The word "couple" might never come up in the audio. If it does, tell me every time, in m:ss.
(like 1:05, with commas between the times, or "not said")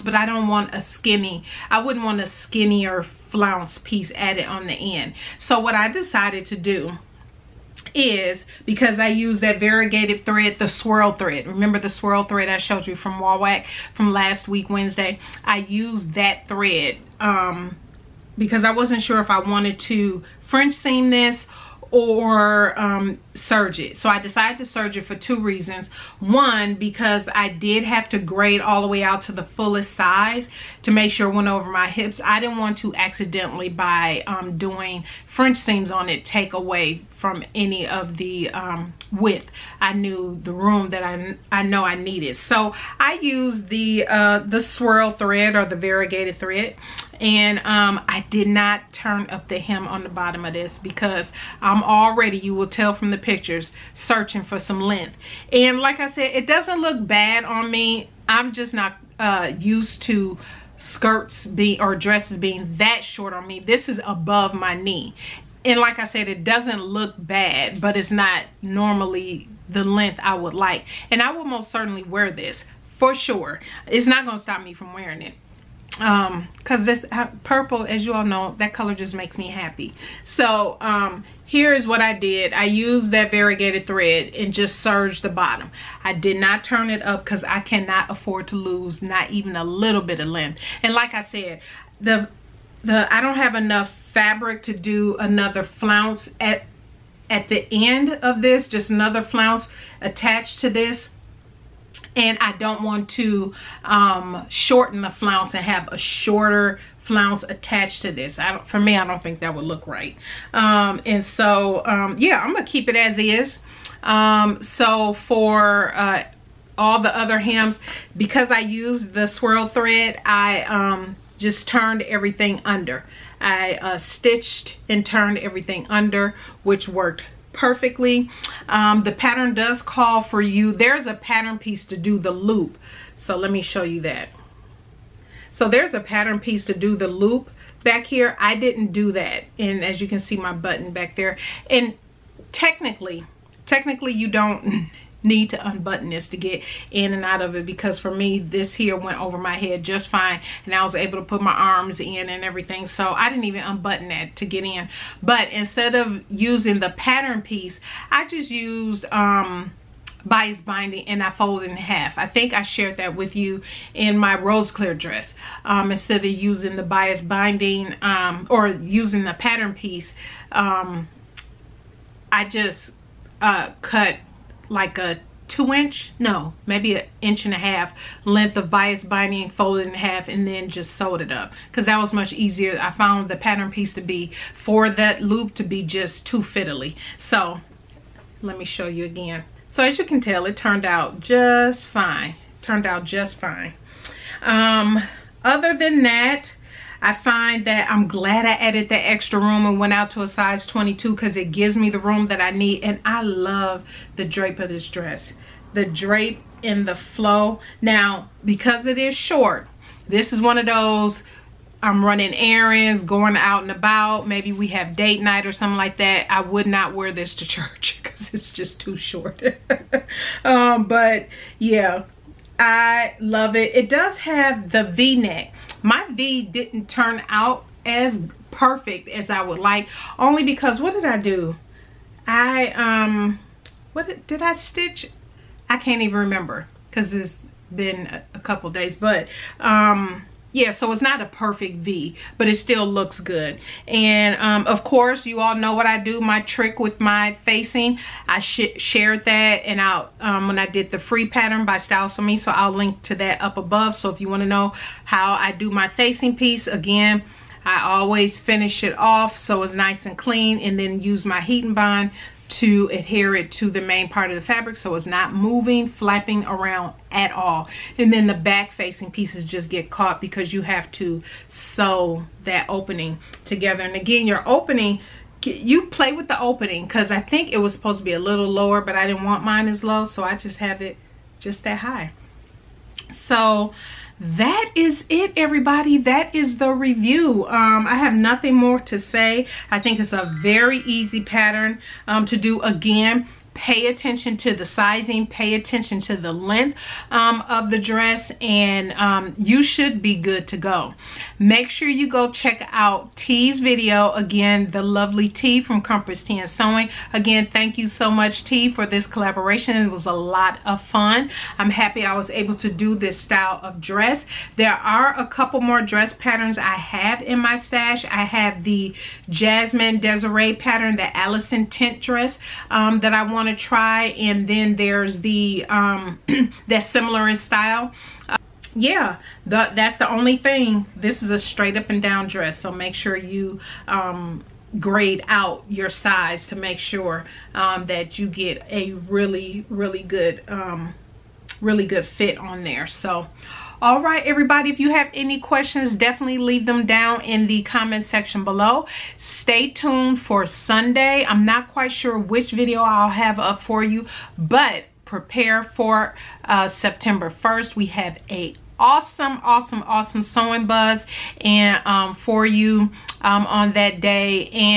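3:58, 5:15.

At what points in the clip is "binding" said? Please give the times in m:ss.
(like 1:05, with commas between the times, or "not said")
2:40, 2:47, 2:59.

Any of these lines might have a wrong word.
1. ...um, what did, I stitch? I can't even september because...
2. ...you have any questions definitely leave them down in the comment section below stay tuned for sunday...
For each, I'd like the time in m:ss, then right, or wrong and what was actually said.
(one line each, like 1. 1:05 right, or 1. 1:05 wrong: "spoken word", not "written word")
1. 3:52 wrong: "remember", not "september"
2. 5:44 right.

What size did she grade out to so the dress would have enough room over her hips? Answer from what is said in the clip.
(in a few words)
22.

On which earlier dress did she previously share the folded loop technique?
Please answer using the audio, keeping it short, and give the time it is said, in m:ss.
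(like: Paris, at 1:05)
rose clear dress, at 2:44.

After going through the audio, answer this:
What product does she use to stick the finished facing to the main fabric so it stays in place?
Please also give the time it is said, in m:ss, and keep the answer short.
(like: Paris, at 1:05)
Heat and Bond, at 4:21.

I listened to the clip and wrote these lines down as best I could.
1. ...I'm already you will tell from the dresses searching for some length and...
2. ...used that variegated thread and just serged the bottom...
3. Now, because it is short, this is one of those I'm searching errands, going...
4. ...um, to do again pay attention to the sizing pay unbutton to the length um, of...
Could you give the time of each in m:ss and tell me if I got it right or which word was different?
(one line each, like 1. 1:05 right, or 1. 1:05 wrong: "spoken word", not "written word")
1. 0:51 wrong: "pictures", not "dresses"
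2. 1:22 right
3. 3:27 wrong: "running", not "searching"
4. 4:52 wrong: "attention", not "unbutton".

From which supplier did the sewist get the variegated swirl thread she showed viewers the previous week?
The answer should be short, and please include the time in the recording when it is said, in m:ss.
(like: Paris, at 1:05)
Wawak, at 0:13.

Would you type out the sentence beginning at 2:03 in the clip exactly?
I uh, stitched and turned everything under, which worked perfectly.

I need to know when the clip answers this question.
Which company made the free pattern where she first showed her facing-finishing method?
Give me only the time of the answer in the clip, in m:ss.
4:11.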